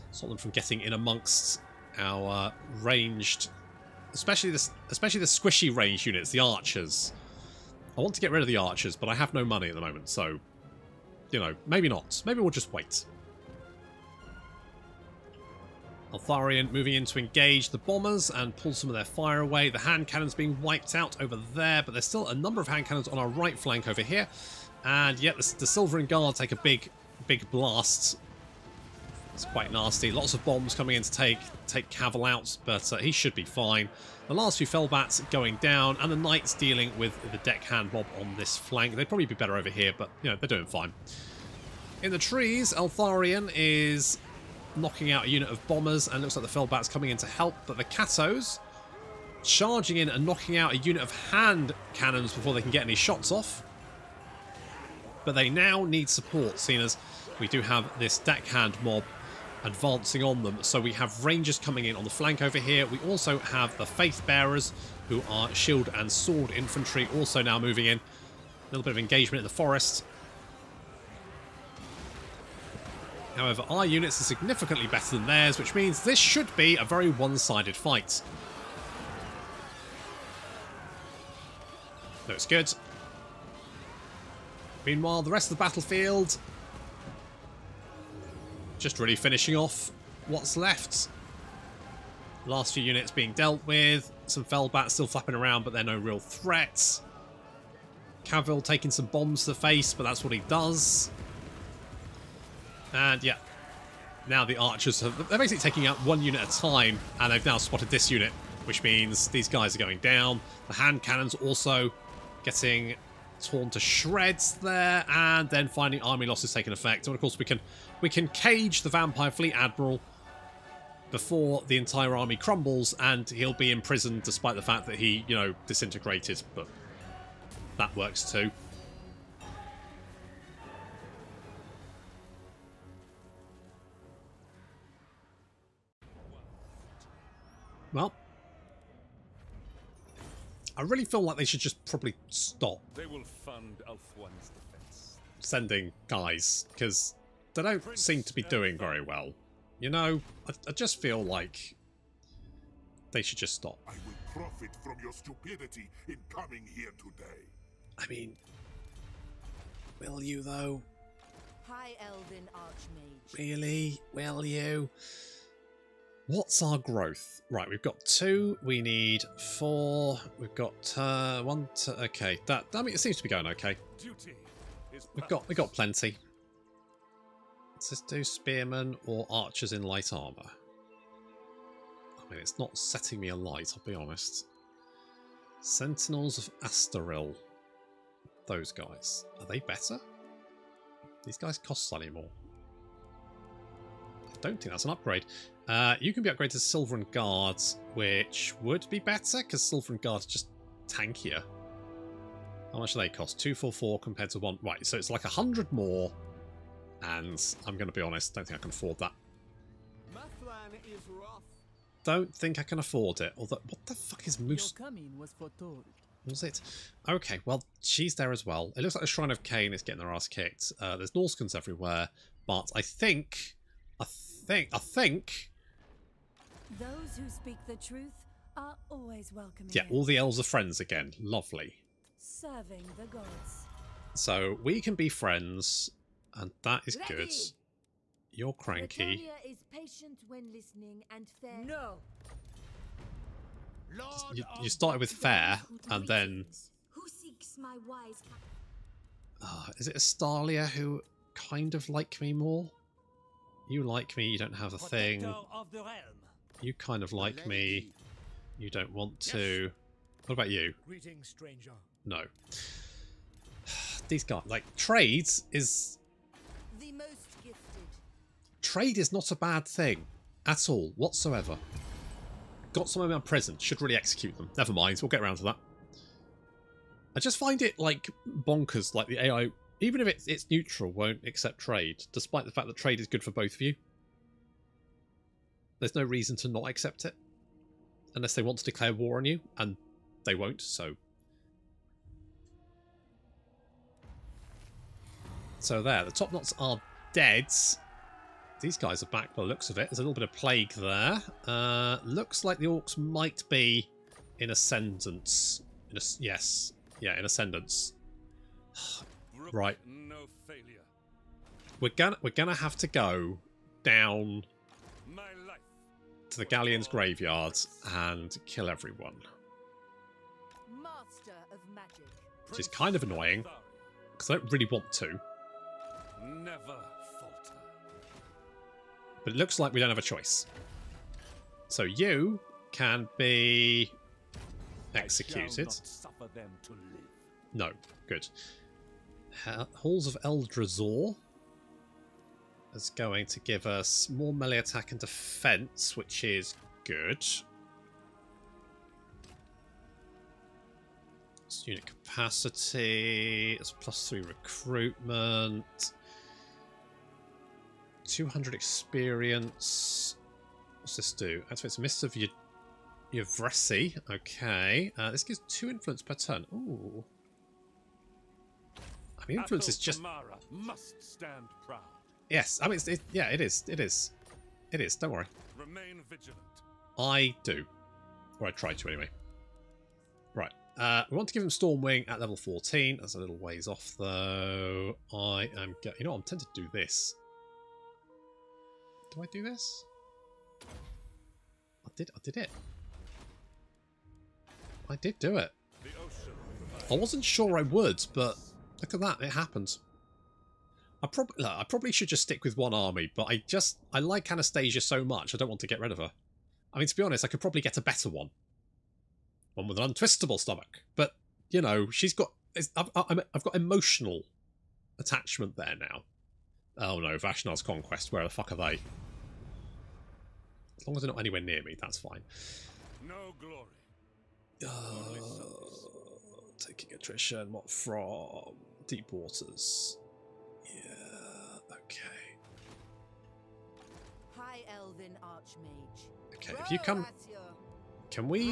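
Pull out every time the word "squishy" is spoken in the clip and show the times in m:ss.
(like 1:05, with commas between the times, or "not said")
0:05.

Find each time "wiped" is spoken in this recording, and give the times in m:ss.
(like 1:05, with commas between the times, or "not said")
0:20.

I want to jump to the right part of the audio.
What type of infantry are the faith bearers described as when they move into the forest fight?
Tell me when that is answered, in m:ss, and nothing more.
1:05.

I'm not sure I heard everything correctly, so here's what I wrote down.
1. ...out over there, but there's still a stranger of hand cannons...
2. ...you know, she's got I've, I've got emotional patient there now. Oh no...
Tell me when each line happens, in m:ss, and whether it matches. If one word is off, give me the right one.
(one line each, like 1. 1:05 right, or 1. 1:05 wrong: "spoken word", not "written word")
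1. 0:20 wrong: "number", not "stranger"
2. 6:51 wrong: "attachment", not "patient".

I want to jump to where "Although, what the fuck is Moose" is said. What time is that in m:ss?
3:33.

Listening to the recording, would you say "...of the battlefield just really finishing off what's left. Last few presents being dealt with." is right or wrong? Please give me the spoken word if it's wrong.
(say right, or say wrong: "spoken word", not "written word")
wrong: "units", not "presents".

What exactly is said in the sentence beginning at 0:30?
Lots of bombs coming in to take take Cavil out, but uh, he should be fine.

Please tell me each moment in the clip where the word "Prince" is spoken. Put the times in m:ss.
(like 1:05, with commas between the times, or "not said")
2:27.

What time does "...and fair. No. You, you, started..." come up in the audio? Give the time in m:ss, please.
4:01.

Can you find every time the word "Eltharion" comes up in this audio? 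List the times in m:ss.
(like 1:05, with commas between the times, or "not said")
0:16, 0:42.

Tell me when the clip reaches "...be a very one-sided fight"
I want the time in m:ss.
1:16.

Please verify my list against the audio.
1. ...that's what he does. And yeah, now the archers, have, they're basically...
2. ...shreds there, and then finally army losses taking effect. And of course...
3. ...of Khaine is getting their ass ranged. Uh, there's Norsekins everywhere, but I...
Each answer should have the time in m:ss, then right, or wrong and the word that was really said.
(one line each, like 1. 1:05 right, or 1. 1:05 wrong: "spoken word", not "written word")
1. 1:40 right
2. 1:53 right
3. 3:39 wrong: "kicked", not "ranged".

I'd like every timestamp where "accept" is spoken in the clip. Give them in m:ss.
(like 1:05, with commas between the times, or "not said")
4:41, 4:46.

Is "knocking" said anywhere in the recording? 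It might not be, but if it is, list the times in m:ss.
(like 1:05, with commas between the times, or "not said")
0:44, 0:50.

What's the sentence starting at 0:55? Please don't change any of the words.
But they now need support, seeing as we do have this deckhand mob advancing on them.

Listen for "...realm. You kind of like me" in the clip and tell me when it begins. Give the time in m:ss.
4:15.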